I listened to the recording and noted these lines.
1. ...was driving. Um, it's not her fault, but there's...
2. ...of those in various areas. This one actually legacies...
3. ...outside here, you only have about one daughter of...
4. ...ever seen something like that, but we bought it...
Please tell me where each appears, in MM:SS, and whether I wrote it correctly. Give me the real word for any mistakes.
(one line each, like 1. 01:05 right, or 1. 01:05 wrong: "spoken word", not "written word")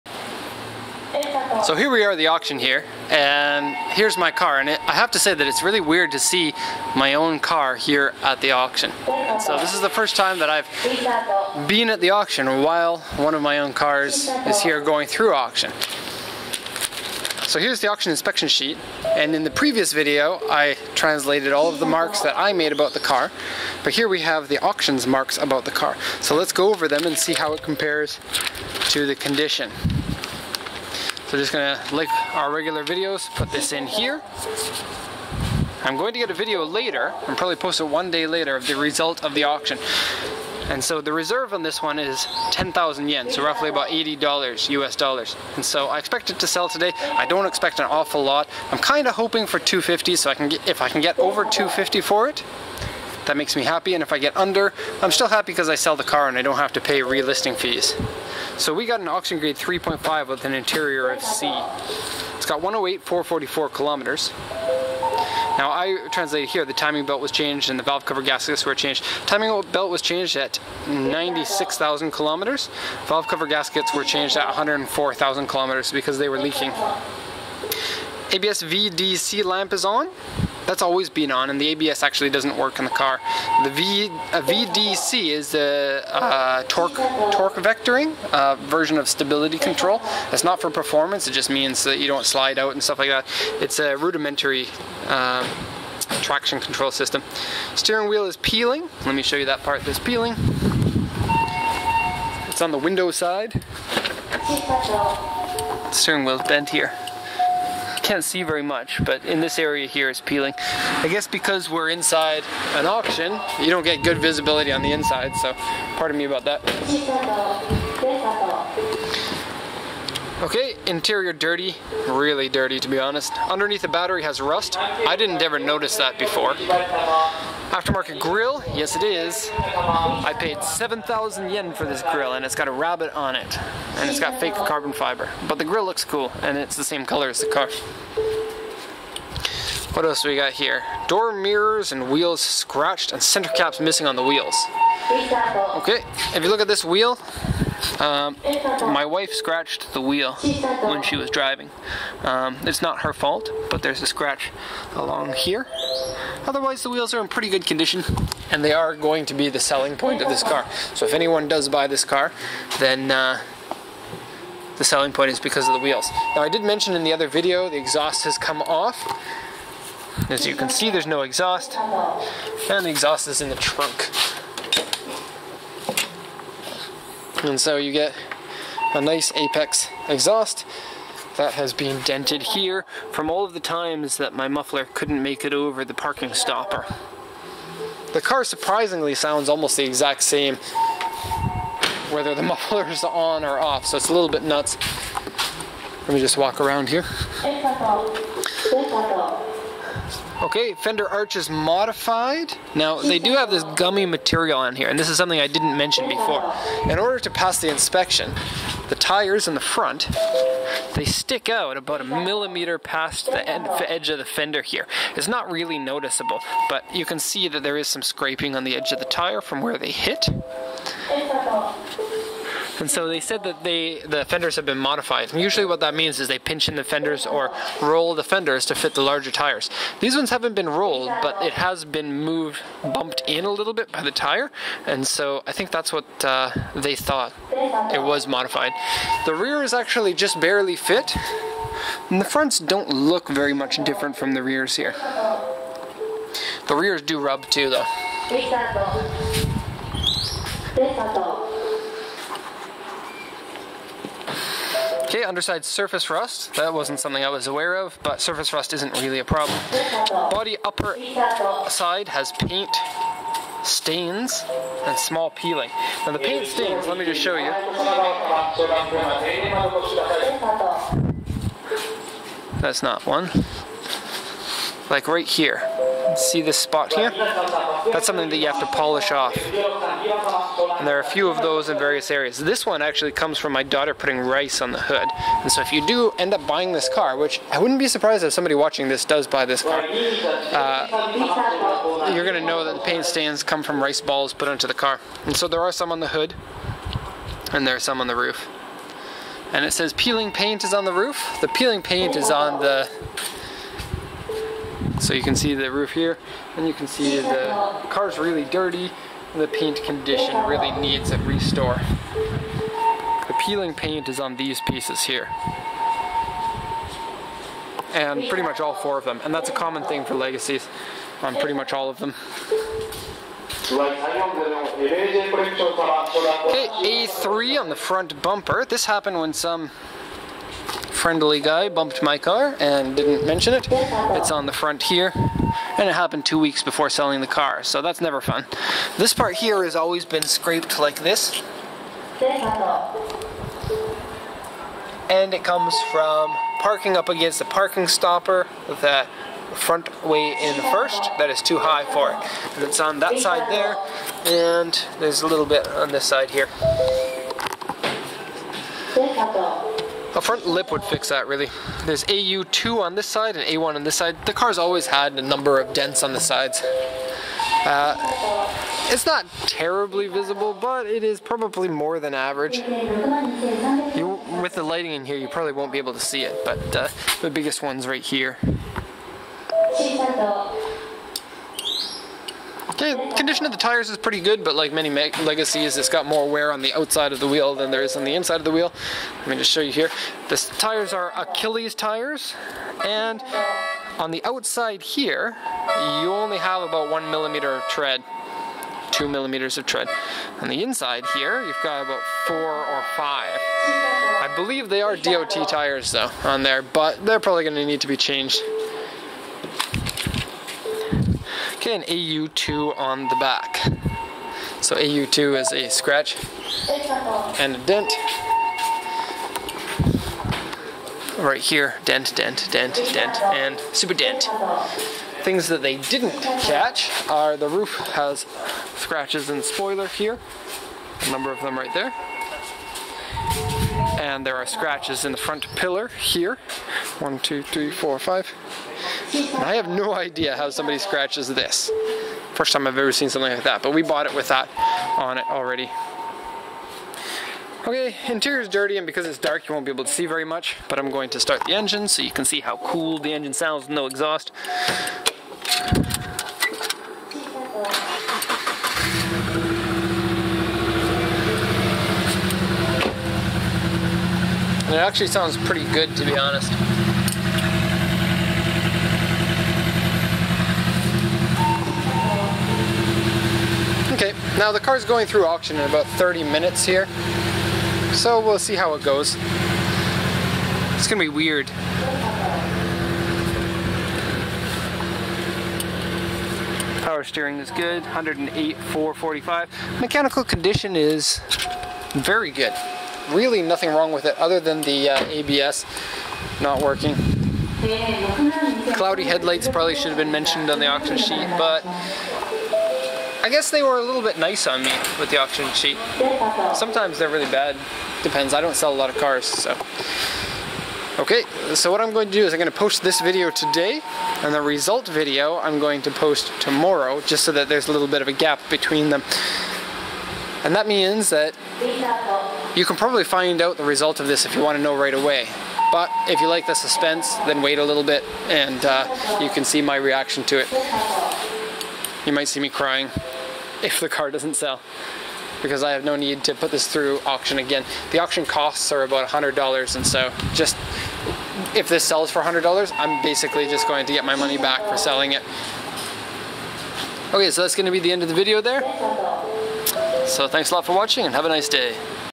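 1. 02:31 right
2. 04:41 wrong: "comes", not "legacies"
3. 06:34 wrong: "millimeter", not "daughter"
4. 07:22 right.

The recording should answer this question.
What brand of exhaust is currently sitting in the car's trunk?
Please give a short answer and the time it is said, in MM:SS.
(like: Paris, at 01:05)
Apex, at 02:59.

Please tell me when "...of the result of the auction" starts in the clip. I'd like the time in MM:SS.
00:38.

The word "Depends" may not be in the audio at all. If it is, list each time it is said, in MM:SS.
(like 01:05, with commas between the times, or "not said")
08:28.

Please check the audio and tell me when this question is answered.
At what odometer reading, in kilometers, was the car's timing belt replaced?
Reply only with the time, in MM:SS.
01:10.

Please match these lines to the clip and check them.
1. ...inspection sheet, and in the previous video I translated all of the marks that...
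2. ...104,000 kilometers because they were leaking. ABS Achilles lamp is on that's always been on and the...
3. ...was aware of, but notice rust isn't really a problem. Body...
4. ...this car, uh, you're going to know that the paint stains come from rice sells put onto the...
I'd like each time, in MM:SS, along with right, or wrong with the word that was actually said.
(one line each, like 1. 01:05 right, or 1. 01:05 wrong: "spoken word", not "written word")
1. 00:18 right
2. 01:14 wrong: "VDC", not "Achilles"
3. 04:17 wrong: "surface", not "notice"
4. 04:49 wrong: "balls", not "sells".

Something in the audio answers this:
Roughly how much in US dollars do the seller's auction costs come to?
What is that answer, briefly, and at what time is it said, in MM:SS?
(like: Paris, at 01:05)
$100, at 08:58.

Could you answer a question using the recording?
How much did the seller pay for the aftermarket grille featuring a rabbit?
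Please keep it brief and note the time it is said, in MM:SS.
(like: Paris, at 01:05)
7,000 yen, at 02:10.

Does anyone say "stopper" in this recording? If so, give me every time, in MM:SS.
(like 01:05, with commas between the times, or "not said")
03:06, 05:47.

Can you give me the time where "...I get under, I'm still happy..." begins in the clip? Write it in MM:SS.
00:54.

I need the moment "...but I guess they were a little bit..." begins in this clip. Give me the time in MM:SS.
08:21.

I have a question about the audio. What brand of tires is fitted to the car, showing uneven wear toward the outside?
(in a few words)
Achilles.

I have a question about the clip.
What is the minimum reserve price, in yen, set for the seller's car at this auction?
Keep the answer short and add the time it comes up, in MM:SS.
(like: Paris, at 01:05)
10,000 yen, at 00:42.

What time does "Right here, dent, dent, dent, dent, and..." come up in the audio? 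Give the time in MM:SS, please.
07:01.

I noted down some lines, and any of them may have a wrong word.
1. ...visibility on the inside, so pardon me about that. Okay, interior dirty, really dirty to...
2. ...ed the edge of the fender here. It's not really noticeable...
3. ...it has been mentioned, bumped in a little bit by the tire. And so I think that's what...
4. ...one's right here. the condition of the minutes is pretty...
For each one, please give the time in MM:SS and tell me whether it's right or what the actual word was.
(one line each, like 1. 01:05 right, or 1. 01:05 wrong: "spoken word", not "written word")
1. 01:54 right
2. 03:33 right
3. 03:51 wrong: "moved", not "mentioned"
4. 06:17 wrong: "tires", not "minutes".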